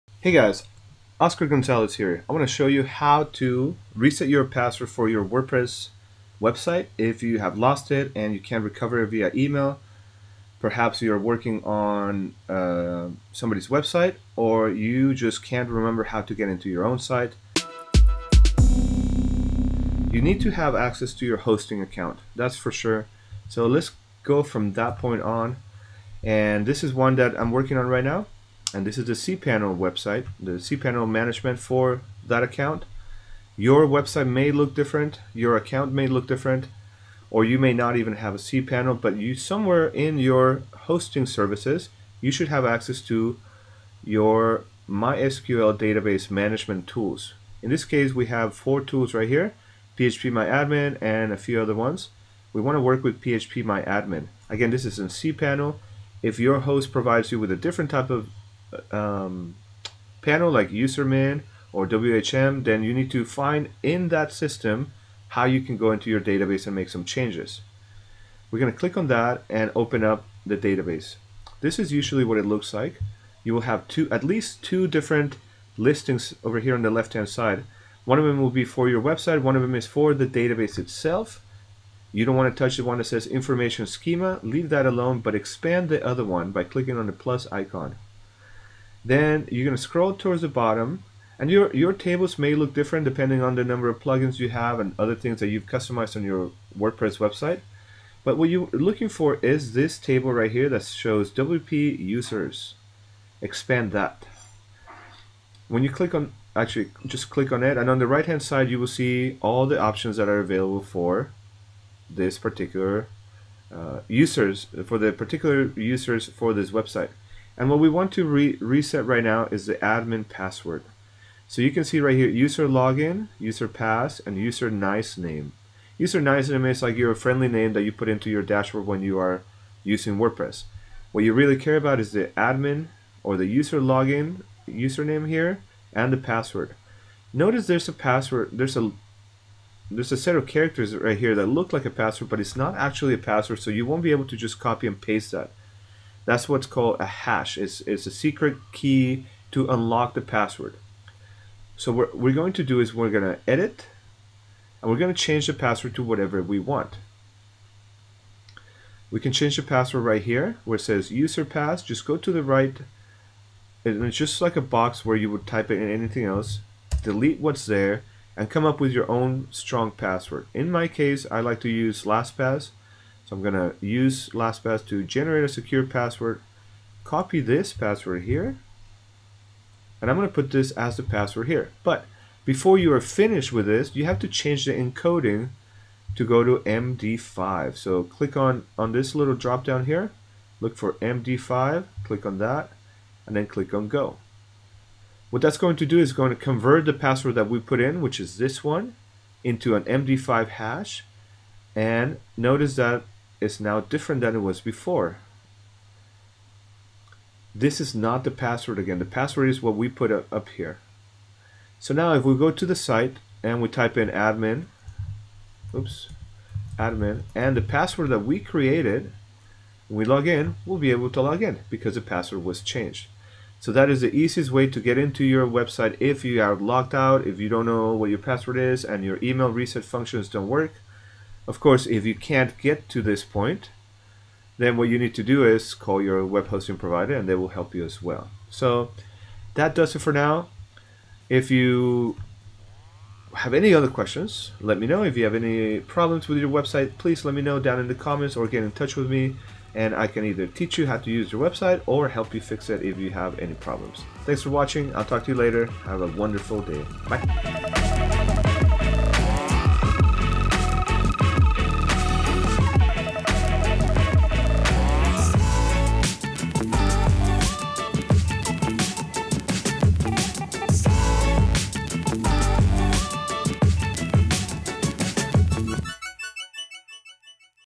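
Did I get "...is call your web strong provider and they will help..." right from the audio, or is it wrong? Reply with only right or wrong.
wrong.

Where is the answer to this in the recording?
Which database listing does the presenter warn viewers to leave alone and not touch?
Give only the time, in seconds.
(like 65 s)
83 s.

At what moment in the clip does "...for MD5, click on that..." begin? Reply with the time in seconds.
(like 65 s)
190 s.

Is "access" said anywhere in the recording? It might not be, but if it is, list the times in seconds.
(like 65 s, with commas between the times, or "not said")
20 s, 42 s.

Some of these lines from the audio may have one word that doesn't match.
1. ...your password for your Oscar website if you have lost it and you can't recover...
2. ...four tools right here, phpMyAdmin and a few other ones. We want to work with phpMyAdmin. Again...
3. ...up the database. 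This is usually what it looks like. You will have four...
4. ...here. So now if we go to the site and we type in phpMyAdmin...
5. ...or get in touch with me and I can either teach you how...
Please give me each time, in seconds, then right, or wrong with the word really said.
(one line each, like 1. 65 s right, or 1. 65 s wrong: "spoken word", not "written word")
1. 4 s wrong: "WordPress", not "Oscar"
2. 48 s right
3. 70 s wrong: "two", not "four"
4. 210 s wrong: "admin", not "phpMyAdmin"
5. 248 s right.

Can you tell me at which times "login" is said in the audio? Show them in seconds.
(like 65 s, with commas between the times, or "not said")
122 s, 133 s.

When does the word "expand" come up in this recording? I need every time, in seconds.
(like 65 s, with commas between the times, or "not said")
85 s, 103 s.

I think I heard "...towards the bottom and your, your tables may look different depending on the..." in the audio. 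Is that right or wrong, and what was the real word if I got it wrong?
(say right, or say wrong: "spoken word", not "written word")
right.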